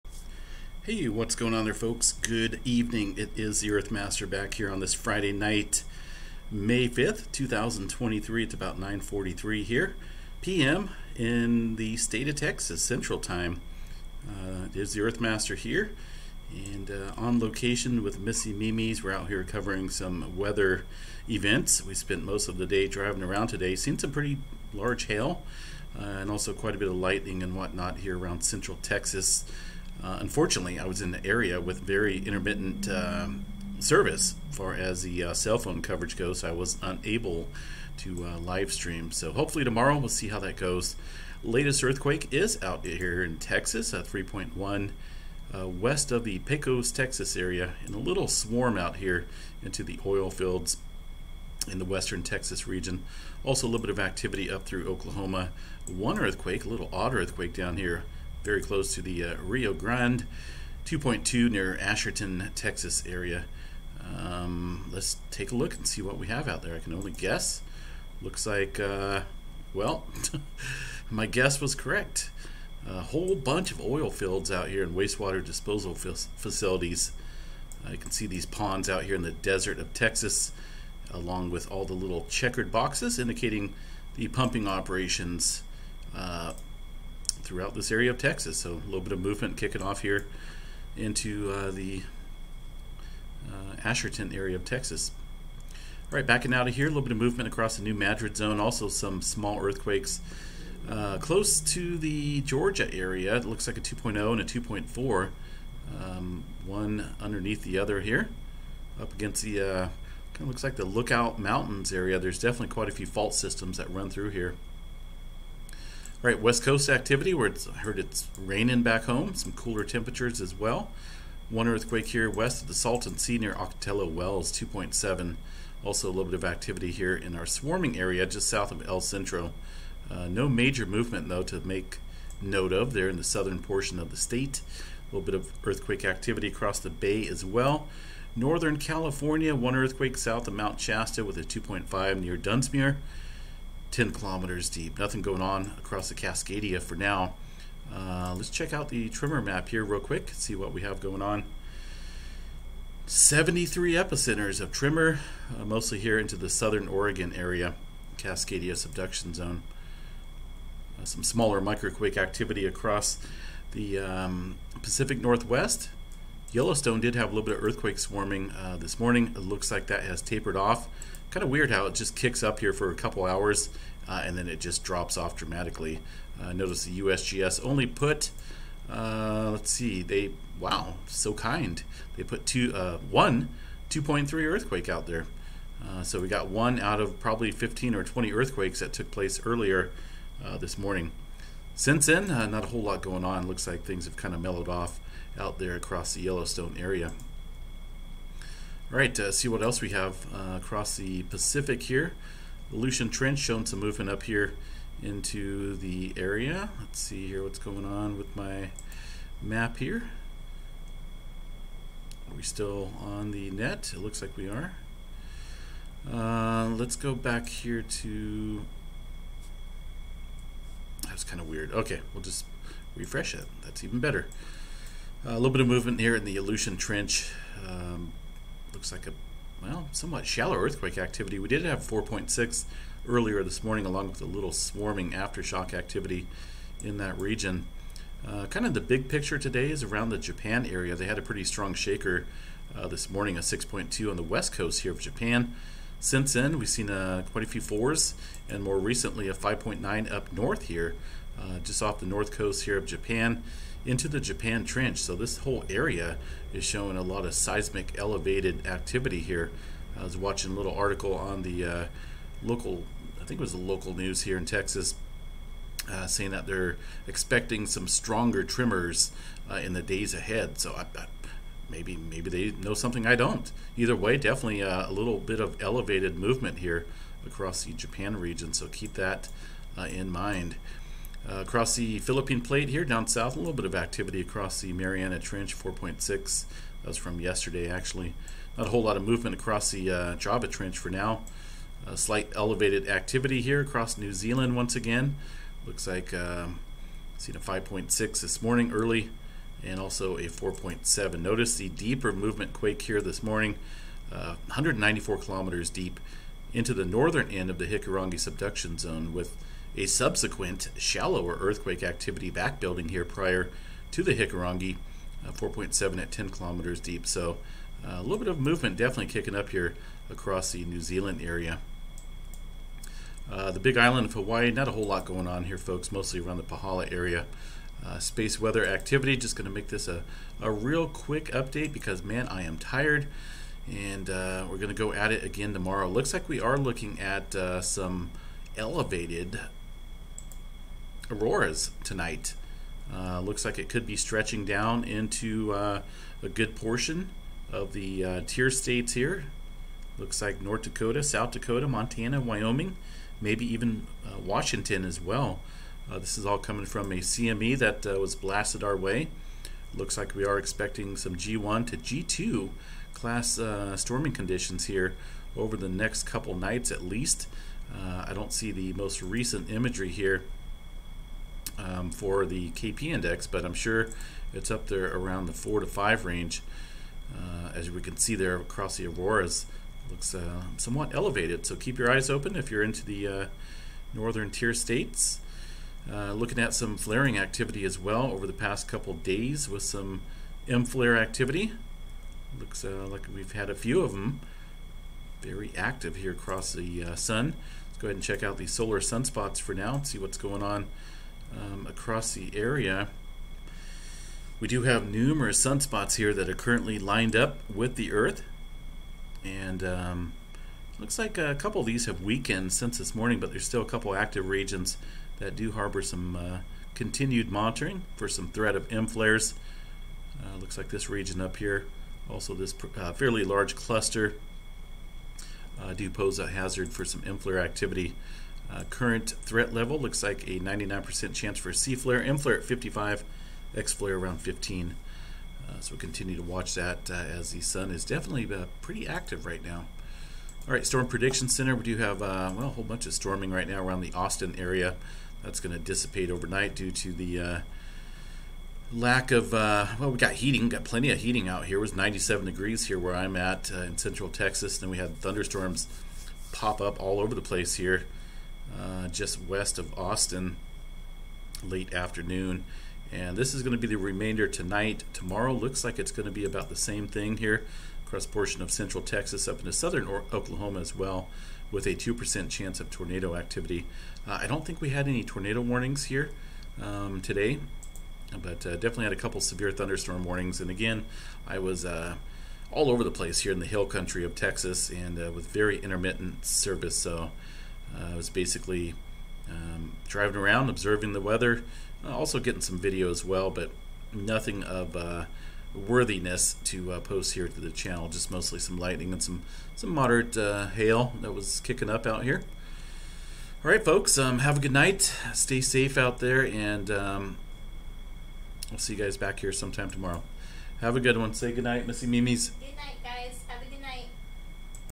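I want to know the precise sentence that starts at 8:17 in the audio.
Just mostly some lightning and some some moderate uh, hail that was kicking up out here.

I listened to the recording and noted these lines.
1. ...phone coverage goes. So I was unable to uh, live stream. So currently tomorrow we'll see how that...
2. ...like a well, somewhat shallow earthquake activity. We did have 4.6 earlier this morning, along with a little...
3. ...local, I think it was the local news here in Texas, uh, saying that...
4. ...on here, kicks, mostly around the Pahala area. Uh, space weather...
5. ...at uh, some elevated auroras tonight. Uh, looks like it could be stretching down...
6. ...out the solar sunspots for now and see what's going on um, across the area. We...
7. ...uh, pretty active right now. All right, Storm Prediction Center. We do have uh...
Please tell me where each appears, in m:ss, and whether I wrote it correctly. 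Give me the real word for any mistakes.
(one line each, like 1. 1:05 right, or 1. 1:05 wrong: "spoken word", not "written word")
1. 0:35 wrong: "hopefully", not "currently"
2. 3:48 right
3. 4:22 right
4. 5:25 wrong: "folks", not "kicks"
5. 5:36 right
6. 6:38 right
7. 7:18 right.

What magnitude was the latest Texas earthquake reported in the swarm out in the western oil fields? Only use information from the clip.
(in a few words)
3.1.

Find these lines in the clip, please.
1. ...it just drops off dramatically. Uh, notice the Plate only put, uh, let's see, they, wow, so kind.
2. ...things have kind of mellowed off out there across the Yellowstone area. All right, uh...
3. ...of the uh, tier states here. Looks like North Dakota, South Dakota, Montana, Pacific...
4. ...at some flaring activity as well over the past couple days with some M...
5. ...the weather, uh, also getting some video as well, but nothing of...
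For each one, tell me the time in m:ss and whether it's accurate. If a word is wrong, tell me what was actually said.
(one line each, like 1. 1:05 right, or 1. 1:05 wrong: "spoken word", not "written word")
1. 2:54 wrong: "USGS", not "Plate"
2. 3:13 right
3. 5:47 wrong: "Wyoming", not "Pacific"
4. 6:26 right
5. 8:10 right.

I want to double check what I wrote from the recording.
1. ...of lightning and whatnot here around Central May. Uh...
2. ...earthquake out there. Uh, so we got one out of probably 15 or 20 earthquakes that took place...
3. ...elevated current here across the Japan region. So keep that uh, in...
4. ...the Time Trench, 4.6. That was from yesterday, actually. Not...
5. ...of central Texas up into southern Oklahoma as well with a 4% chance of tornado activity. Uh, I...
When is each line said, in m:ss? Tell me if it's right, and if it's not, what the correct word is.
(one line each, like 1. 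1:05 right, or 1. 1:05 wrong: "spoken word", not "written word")
1. 0:26 wrong: "Texas", not "May"
2. 3:04 right
3. 4:35 wrong: "movement", not "current"
4. 4:44 wrong: "Mariana", not "Time"
5. 7:48 wrong: "2", not "4".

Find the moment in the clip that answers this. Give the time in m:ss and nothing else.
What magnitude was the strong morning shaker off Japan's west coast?
4:03.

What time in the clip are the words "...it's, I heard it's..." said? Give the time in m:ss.
1:57.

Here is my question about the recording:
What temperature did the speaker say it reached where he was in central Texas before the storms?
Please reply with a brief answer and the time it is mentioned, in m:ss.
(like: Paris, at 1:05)
97 degrees, at 7:31.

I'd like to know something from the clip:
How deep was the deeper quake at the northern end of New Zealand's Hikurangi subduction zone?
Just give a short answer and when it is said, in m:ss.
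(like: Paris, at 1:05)
194 kilometers, at 5:04.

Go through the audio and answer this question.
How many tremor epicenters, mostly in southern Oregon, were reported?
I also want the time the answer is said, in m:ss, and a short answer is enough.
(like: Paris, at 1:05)
73, at 2:33.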